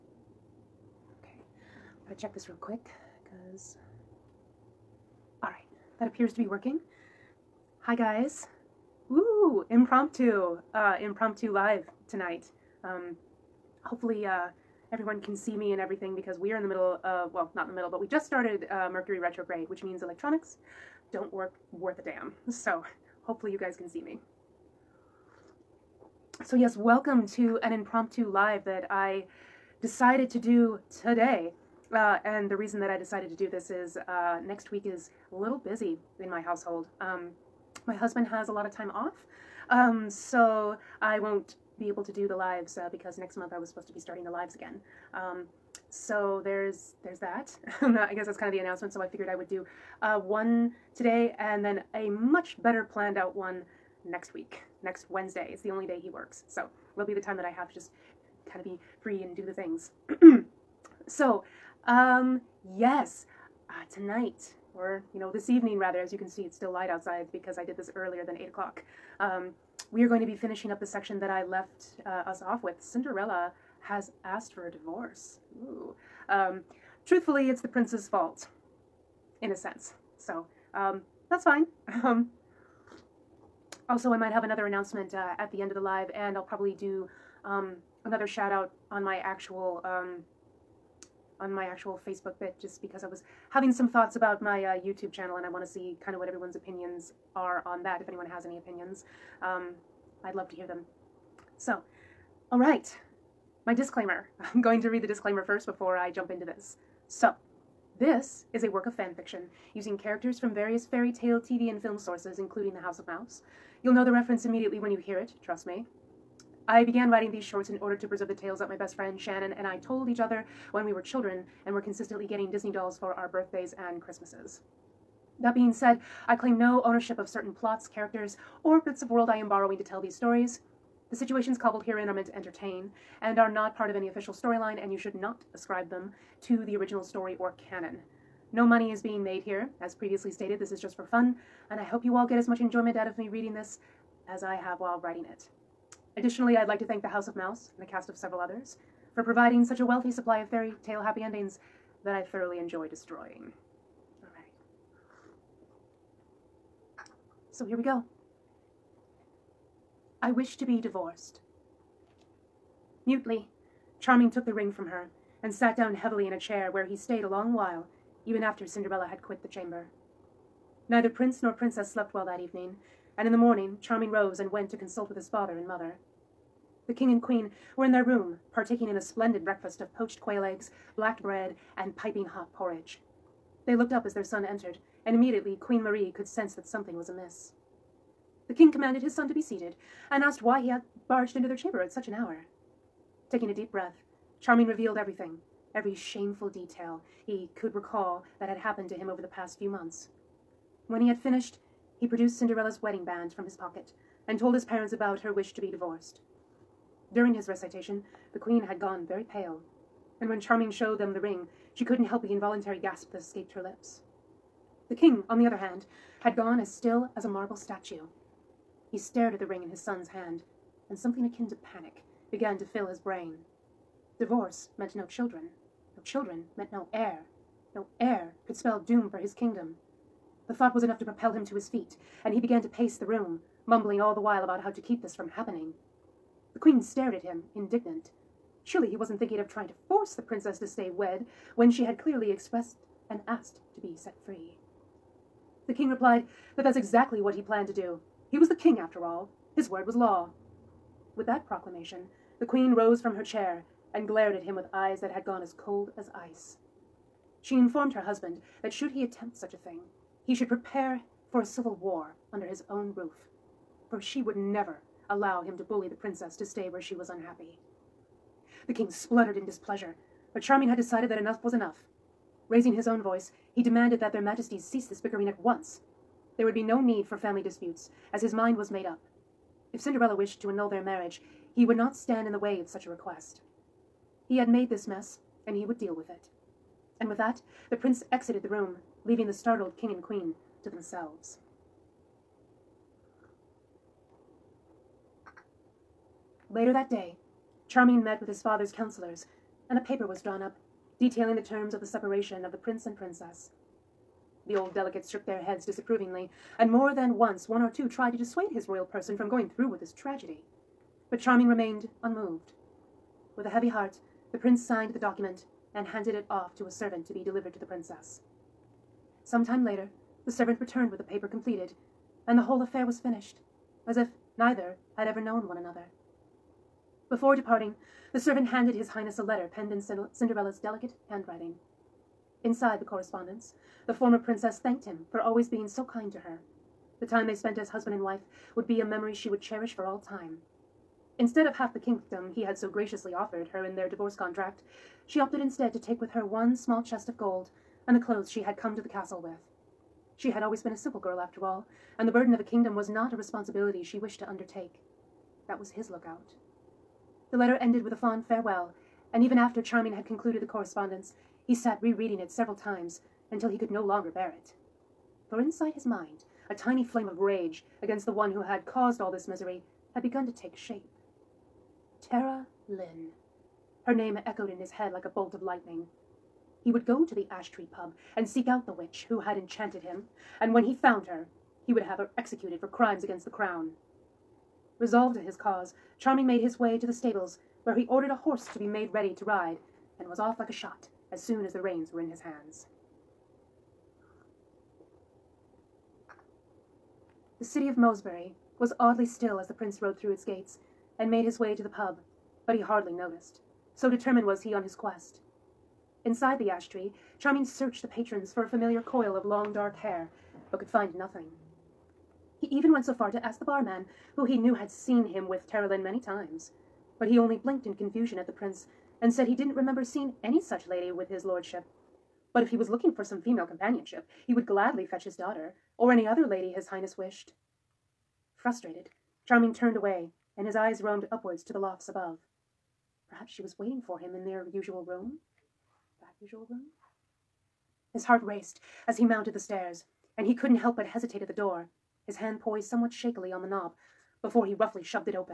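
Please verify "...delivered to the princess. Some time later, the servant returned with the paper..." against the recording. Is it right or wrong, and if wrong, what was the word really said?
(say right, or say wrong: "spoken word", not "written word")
right.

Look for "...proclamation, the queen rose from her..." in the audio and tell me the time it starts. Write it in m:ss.
4:11.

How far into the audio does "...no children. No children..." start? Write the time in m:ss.
3:44.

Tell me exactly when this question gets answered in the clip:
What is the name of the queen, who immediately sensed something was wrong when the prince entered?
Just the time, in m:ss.
3:05.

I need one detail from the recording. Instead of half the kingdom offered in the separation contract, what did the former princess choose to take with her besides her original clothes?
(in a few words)
One small chest of gold.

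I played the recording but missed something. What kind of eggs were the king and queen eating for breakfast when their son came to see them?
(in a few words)
Poached quail eggs.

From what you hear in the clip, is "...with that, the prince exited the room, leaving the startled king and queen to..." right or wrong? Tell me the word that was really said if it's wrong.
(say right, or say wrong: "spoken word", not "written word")
right.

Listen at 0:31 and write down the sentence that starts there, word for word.
Uh, and the reason that I decided to do this is uh, next week is a little busy in my household.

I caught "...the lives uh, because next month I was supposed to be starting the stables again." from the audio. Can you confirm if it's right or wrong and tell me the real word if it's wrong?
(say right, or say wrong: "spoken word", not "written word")
wrong: "lives", not "stables".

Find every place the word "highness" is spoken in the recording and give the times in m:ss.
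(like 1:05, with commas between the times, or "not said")
5:28, 7:06.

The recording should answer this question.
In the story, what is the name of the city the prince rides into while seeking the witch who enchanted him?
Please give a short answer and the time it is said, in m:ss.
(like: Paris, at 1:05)
Mosebury, at 6:37.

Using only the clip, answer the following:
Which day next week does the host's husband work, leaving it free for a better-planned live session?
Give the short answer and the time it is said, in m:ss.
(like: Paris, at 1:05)
Wednesday, at 0:54.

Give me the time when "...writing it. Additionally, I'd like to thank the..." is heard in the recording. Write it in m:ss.
2:24.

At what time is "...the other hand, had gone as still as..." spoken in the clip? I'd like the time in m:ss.
3:35.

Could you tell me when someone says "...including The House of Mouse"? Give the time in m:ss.
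1:52.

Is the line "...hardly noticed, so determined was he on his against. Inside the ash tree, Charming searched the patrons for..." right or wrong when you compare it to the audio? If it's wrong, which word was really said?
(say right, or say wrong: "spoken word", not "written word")
wrong: "quest", not "against".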